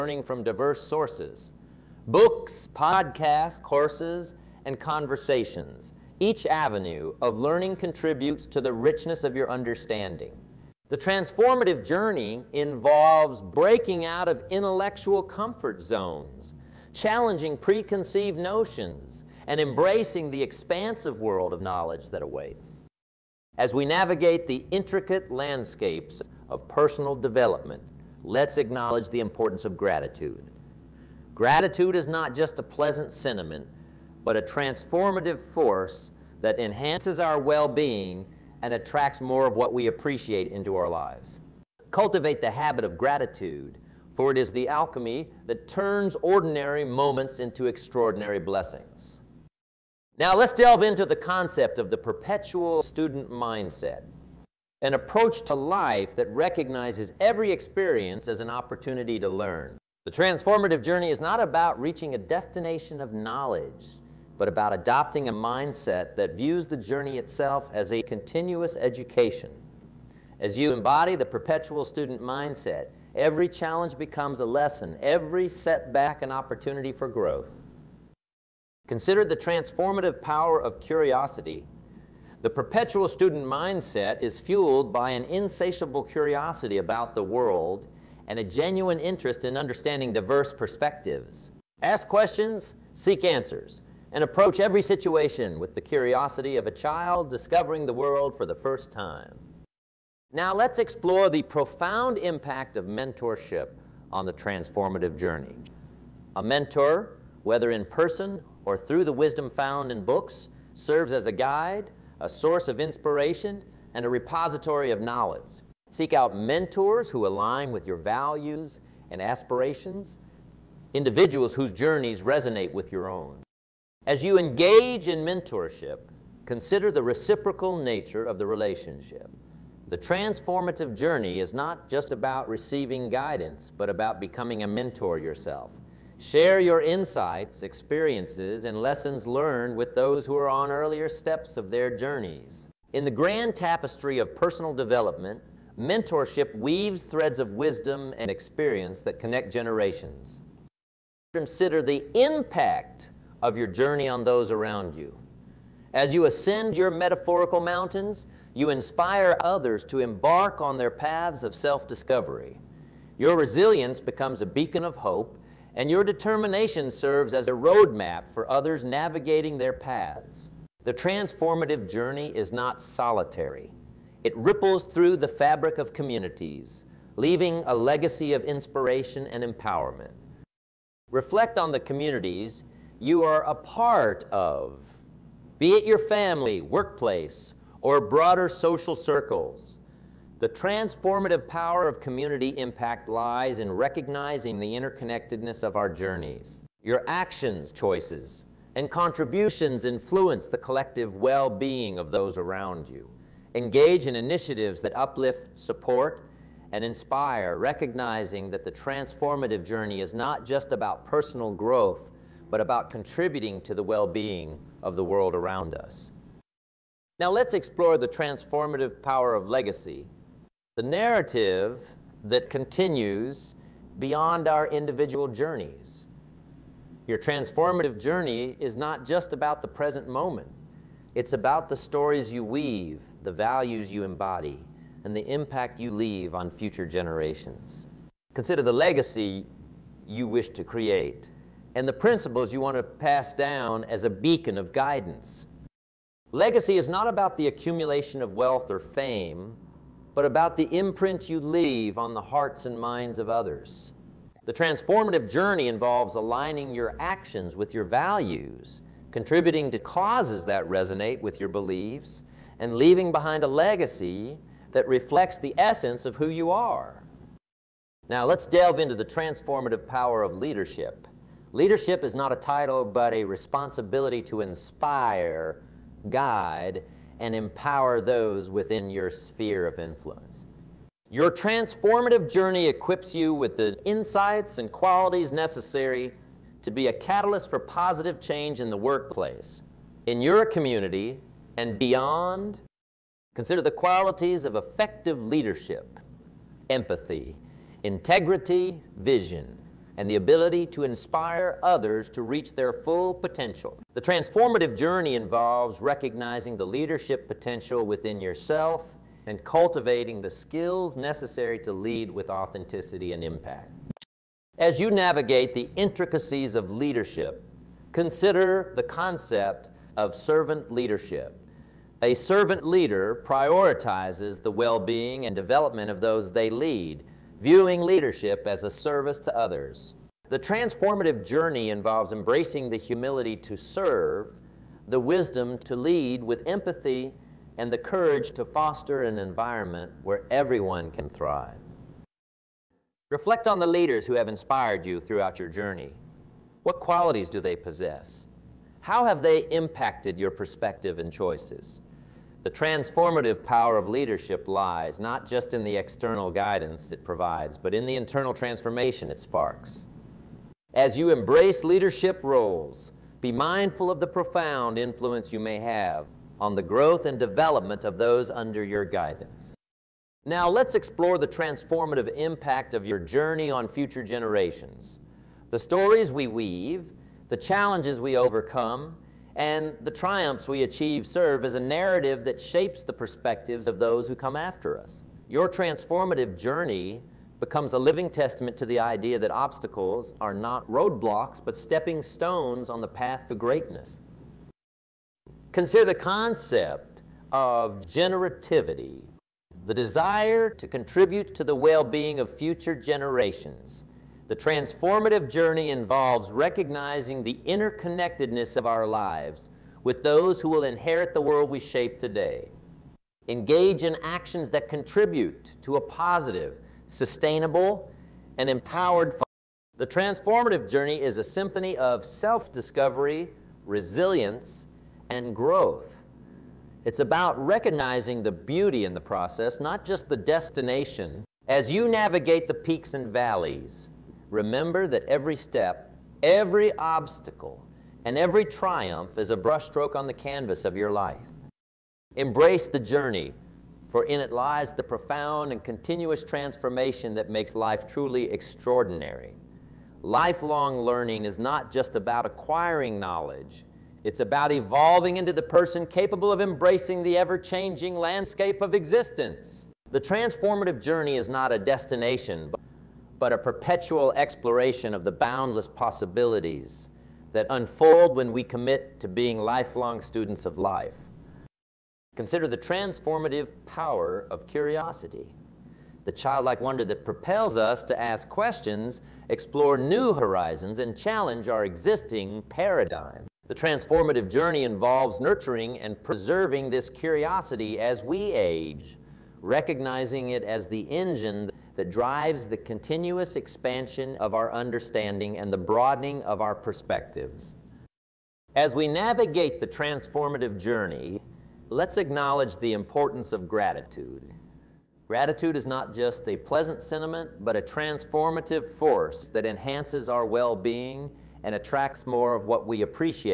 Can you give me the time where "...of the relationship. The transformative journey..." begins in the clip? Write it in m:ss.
2:08.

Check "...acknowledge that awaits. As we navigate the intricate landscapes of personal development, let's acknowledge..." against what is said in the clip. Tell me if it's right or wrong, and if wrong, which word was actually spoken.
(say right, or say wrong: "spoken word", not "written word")
wrong: "knowledge", not "acknowledge".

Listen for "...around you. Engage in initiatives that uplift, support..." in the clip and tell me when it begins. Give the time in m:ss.
3:22.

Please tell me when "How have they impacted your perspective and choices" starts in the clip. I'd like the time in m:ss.
5:48.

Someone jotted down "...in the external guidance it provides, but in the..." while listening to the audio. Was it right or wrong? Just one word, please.
right.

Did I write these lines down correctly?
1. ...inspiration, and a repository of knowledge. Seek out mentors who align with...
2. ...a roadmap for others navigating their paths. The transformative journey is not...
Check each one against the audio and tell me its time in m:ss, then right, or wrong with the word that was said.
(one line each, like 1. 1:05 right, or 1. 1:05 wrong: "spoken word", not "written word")
1. 1:52 right
2. 2:47 right.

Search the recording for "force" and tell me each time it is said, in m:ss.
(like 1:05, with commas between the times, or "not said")
0:35, 8:28.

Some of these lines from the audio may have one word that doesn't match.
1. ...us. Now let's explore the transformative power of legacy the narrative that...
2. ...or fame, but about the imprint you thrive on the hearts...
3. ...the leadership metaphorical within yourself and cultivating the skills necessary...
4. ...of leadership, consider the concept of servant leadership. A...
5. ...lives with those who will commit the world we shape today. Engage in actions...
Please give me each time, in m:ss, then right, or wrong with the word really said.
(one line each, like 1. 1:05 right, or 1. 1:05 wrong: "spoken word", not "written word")
1. 3:35 right
2. 4:08 wrong: "leave", not "thrive"
3. 5:06 wrong: "potential", not "metaphorical"
4. 5:16 right
5. 6:48 wrong: "inherit", not "commit".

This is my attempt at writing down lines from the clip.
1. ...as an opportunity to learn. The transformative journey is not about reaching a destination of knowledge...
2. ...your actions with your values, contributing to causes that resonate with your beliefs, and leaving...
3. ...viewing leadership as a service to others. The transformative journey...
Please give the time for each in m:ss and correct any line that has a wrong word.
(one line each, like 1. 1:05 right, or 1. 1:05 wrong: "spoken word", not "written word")
1. 0:58 right
2. 4:16 right
3. 5:27 right.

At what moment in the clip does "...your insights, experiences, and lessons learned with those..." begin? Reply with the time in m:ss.
2:16.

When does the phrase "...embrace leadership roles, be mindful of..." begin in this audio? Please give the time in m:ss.
6:01.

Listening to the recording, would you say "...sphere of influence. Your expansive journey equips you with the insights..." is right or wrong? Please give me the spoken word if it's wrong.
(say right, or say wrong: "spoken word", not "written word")
wrong: "transformative", not "expansive".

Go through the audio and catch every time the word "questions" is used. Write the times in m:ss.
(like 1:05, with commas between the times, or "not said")
1:32, 7:58.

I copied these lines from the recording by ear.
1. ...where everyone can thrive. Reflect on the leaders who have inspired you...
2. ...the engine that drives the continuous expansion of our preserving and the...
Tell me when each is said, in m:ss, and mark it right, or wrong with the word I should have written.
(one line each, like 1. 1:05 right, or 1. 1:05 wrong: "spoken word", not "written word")
1. 5:40 right
2. 8:10 wrong: "understanding", not "preserving".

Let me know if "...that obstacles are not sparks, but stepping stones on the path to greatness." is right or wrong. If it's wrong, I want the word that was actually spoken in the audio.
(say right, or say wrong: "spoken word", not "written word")
wrong: "roadblocks", not "sparks".